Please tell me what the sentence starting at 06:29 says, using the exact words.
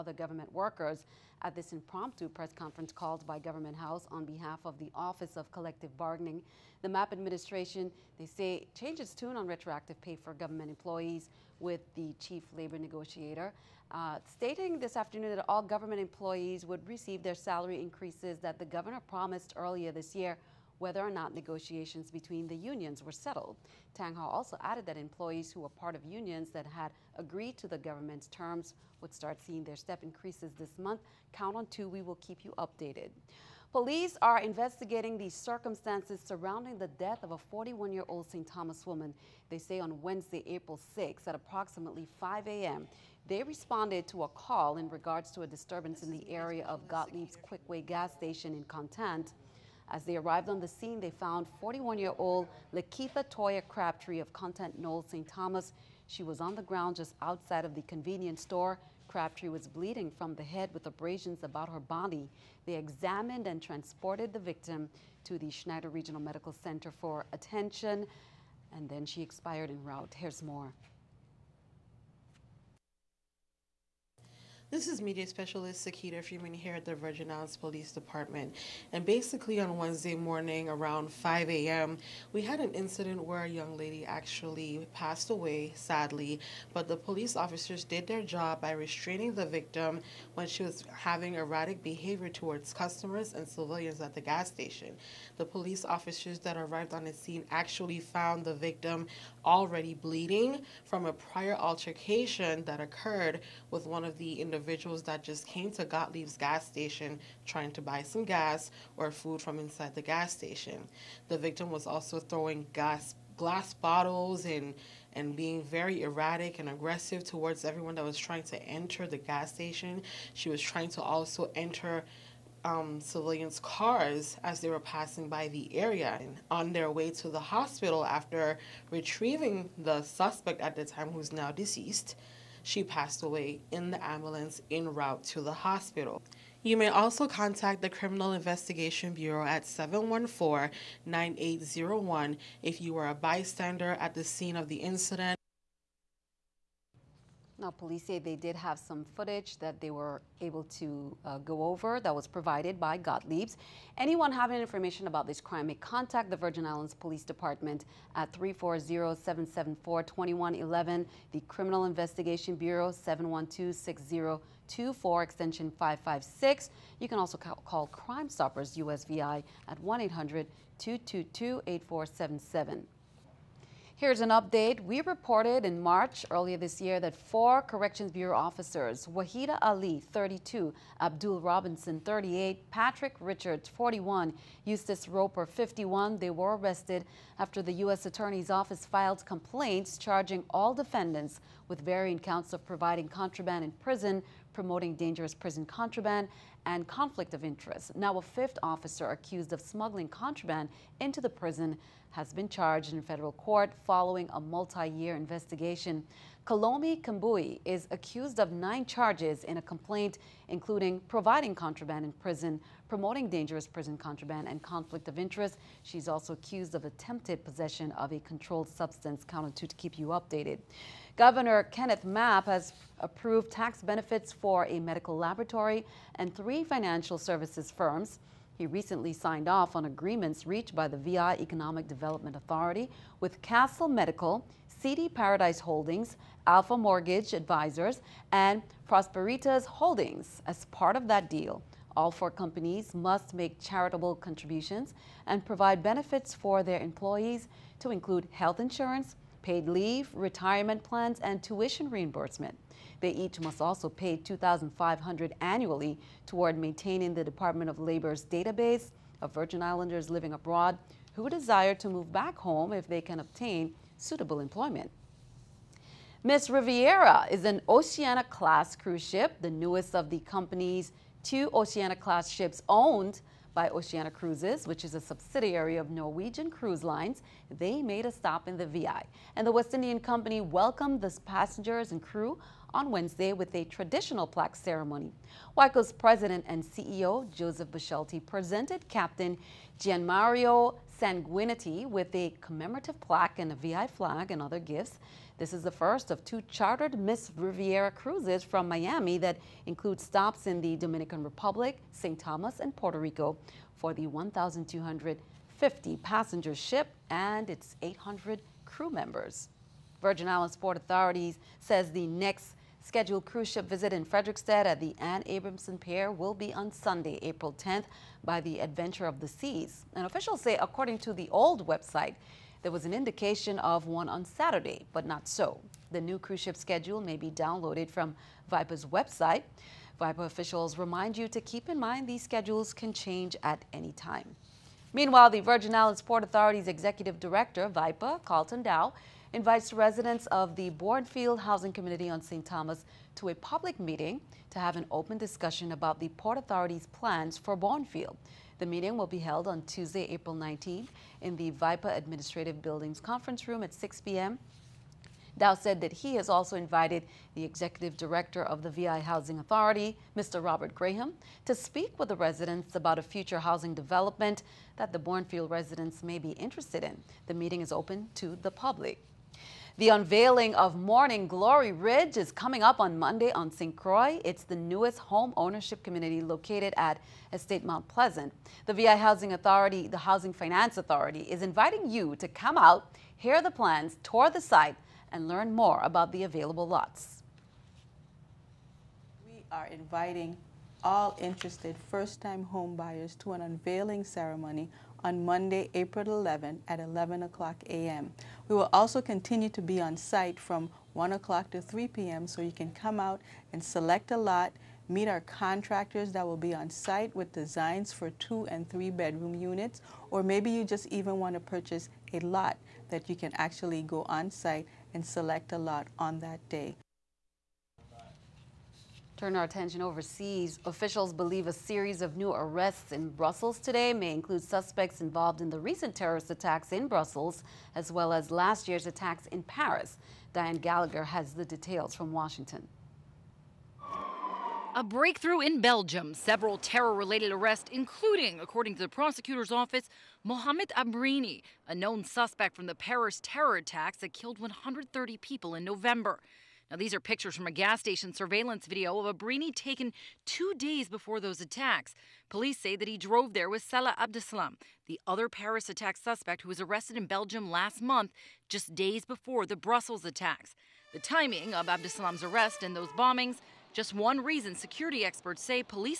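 We are inviting all interested first-time homebuyers to an unveiling ceremony on Monday, April 11 at 11 o'clock a.m.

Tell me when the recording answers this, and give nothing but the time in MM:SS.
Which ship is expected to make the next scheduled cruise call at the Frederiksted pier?
05:18.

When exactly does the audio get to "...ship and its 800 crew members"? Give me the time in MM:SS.
05:06.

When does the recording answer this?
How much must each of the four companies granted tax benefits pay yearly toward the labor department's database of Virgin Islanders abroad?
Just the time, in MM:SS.
04:14.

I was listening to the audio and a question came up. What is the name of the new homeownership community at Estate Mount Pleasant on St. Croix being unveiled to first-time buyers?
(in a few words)
Morning Glory Ridge.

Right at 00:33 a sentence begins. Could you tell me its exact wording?
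Police are investigating the circumstances surrounding the death of a 41-year-old St.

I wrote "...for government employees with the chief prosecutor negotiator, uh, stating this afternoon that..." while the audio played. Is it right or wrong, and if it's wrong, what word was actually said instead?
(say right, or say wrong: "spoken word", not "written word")
wrong: "labor", not "prosecutor".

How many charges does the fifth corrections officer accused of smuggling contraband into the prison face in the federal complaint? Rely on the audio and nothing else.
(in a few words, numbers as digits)
9.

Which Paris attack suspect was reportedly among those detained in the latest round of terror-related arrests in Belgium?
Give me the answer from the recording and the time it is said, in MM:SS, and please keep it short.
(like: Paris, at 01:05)
Mohamed Abrini, at 07:20.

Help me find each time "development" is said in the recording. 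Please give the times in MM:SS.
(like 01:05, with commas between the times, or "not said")
03:51, 06:03.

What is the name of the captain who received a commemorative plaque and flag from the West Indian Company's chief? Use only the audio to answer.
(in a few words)
Gianmario Sanguineti.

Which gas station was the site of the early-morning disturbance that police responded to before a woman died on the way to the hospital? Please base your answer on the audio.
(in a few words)
Gottlieb's Quickway.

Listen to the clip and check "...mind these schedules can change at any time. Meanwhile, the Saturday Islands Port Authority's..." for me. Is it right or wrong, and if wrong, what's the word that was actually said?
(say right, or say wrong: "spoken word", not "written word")
wrong: "Virgin", not "Saturday".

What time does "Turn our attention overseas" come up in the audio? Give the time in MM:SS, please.
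06:59.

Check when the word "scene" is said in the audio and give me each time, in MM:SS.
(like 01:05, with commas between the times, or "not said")
00:50, 01:37, 02:24.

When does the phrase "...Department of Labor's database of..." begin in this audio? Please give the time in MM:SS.
04:17.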